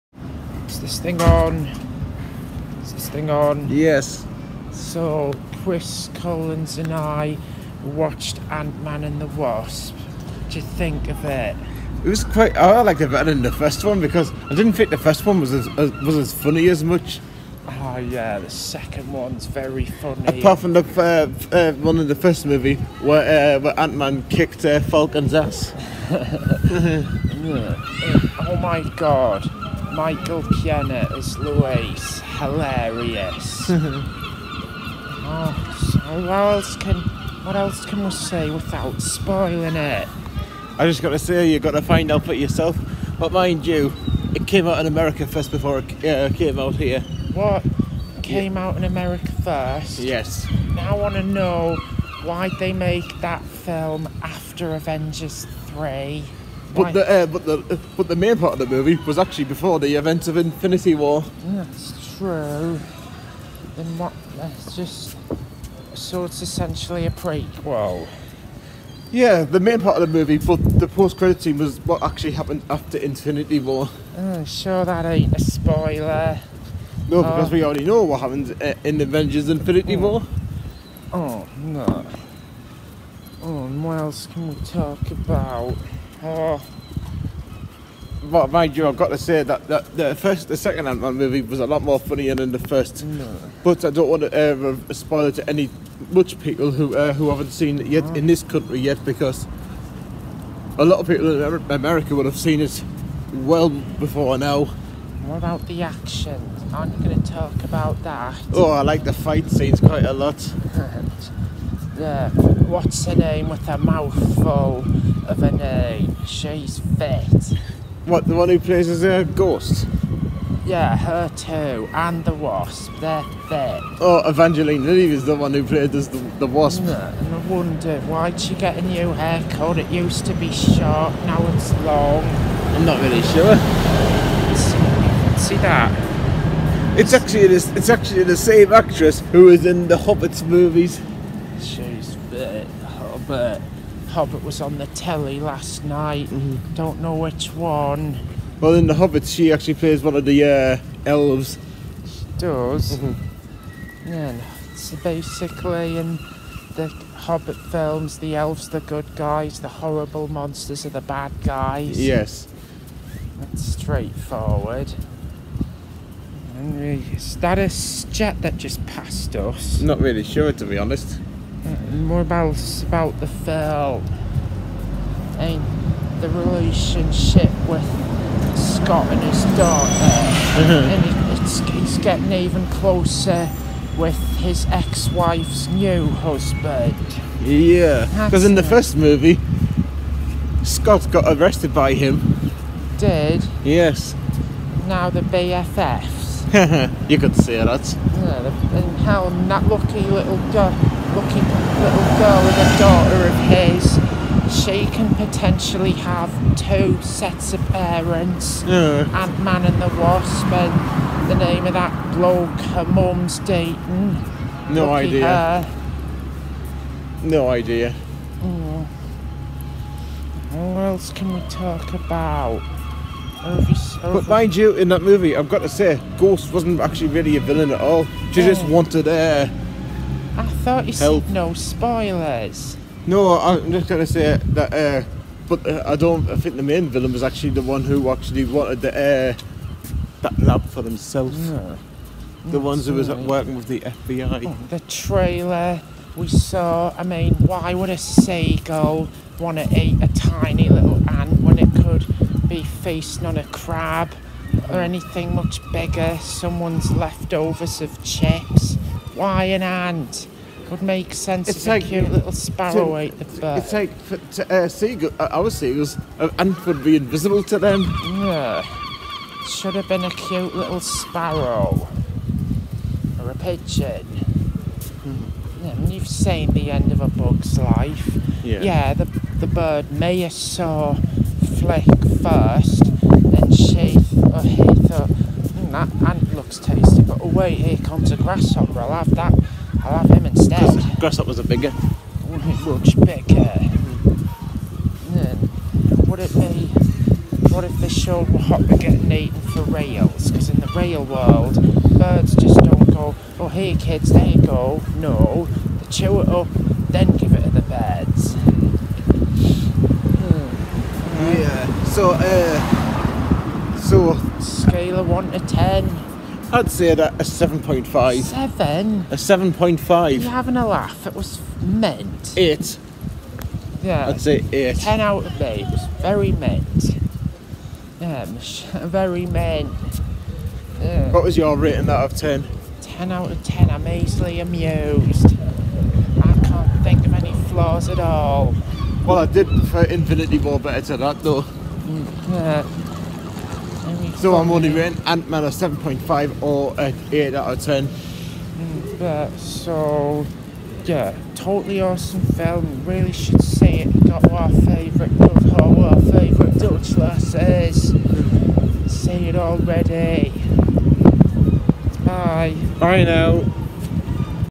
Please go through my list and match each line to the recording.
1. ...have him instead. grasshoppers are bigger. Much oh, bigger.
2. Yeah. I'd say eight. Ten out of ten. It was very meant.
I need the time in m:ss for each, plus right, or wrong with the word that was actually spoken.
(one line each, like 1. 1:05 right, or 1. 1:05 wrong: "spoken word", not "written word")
1. 4:49 right
2. 5:23 right.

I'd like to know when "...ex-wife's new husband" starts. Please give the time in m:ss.
3:04.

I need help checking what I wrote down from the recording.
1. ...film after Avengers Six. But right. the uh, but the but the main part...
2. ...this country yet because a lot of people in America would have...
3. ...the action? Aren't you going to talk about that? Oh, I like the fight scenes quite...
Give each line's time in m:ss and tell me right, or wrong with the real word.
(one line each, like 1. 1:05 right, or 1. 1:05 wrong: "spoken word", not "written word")
1. 0:53 wrong: "Three", not "Six"
2. 1:38 right
3. 1:45 right.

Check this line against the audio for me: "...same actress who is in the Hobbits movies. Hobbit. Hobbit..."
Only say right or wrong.
right.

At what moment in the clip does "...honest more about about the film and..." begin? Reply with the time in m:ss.
2:50.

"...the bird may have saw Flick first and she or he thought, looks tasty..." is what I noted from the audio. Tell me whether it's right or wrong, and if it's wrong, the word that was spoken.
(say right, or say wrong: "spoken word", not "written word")
right.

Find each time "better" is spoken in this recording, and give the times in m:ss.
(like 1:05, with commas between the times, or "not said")
0:13, 5:40.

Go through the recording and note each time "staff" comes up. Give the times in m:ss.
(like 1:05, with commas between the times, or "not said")
not said.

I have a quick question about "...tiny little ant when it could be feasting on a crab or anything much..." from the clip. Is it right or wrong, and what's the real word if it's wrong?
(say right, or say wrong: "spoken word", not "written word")
right.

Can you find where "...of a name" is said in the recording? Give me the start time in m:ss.
1:55.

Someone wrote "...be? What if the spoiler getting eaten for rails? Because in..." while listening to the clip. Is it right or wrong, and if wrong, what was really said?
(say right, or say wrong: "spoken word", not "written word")
wrong: "shoalhopper", not "spoiler".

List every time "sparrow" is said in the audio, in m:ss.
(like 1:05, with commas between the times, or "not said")
4:22, 4:30.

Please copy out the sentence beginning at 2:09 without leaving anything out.
It used to be short, now it's long.